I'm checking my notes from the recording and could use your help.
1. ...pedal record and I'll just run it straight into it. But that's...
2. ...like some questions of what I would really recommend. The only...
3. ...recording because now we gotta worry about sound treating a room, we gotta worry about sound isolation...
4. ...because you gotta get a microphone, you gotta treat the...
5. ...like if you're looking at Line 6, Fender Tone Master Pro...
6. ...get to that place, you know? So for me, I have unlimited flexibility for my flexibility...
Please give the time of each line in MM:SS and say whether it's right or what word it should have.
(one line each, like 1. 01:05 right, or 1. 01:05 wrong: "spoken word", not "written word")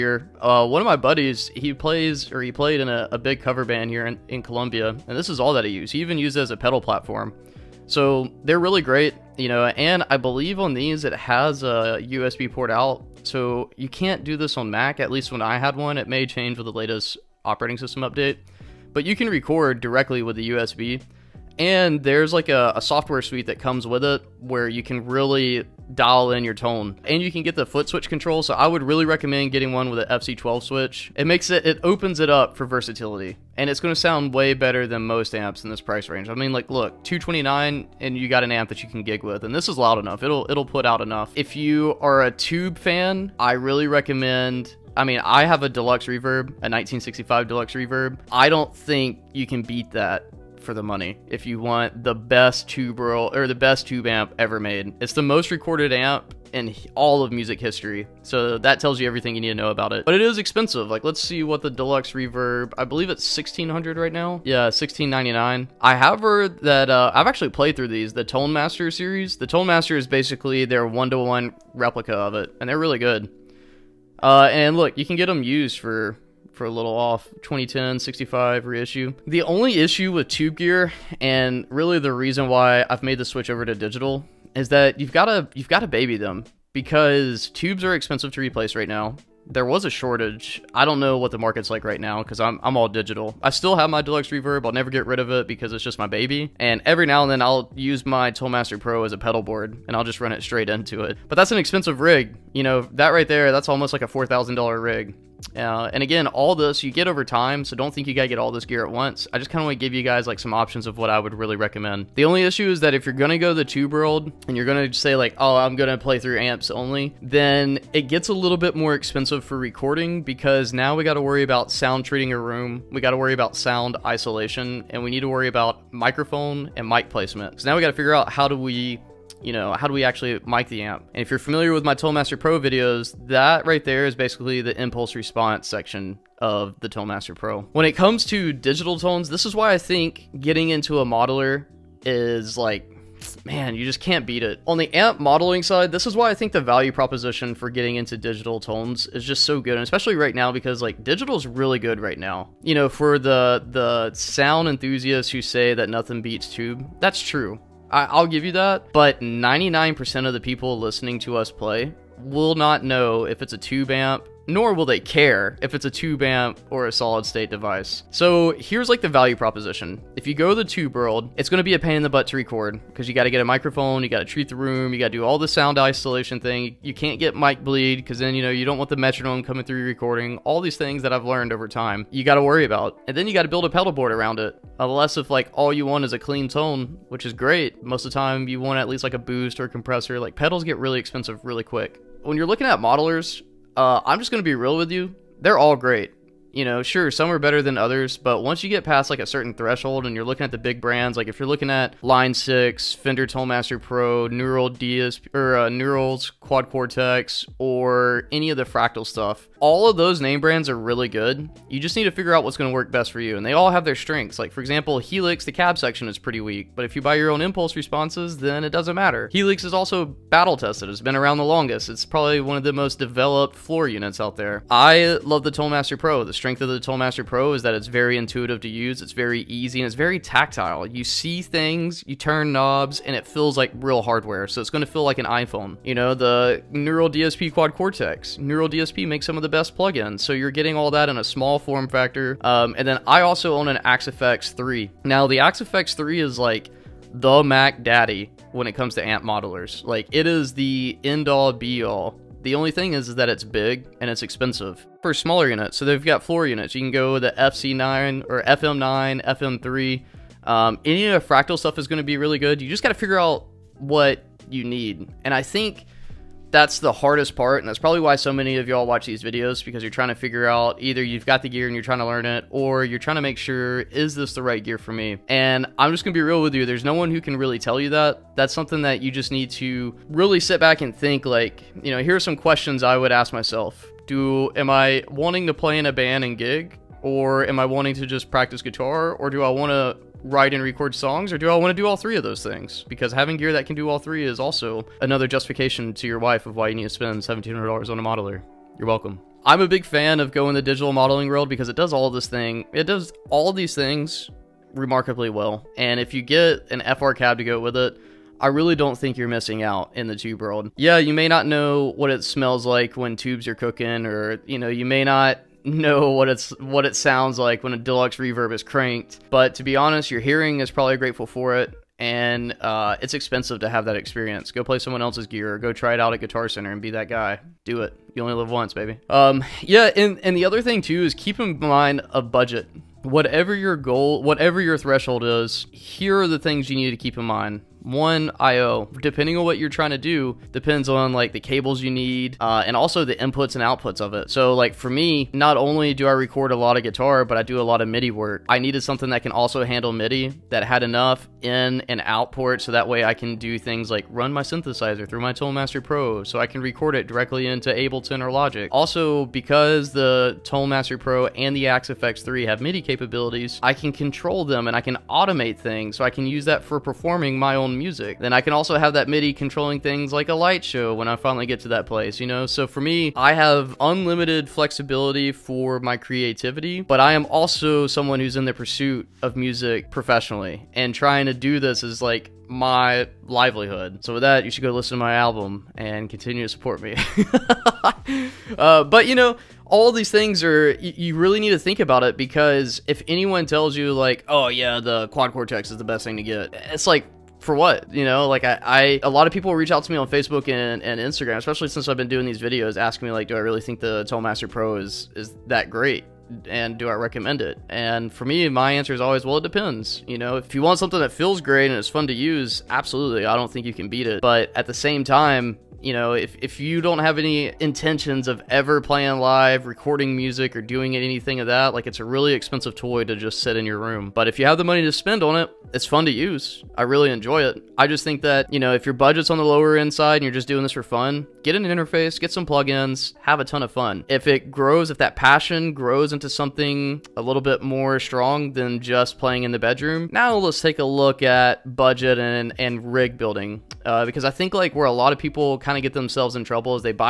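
1. 01:39 wrong: "board", not "record"
2. 01:50 wrong: "options", not "questions"
3. 01:59 right
4. 02:52 right
5. 03:21 right
6. 06:11 wrong: "creativity", not "flexibility".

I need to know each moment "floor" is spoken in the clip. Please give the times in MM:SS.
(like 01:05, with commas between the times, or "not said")
03:43, 04:16.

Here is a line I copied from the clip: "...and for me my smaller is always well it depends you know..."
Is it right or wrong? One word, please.
wrong.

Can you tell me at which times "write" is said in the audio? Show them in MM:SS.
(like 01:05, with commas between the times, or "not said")
04:50.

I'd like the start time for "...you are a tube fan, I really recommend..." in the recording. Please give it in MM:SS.
00:41.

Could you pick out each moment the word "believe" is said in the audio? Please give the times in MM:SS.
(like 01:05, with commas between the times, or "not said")
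00:10, 01:02.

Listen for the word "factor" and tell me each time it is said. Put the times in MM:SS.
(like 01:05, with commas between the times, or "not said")
04:01.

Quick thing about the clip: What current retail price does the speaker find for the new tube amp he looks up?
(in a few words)
$1,699.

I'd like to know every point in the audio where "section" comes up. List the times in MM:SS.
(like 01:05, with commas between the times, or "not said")
02:15, 03:35.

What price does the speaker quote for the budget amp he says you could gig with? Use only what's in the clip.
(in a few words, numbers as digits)
229.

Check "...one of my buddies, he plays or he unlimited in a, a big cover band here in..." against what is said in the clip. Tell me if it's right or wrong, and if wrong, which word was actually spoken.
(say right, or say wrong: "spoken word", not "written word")
wrong: "played", not "unlimited".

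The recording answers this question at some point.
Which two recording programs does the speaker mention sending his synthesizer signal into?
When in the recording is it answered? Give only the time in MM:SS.
05:57.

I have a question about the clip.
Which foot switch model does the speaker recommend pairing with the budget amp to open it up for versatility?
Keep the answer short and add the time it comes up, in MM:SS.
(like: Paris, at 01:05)
FC12, at 00:30.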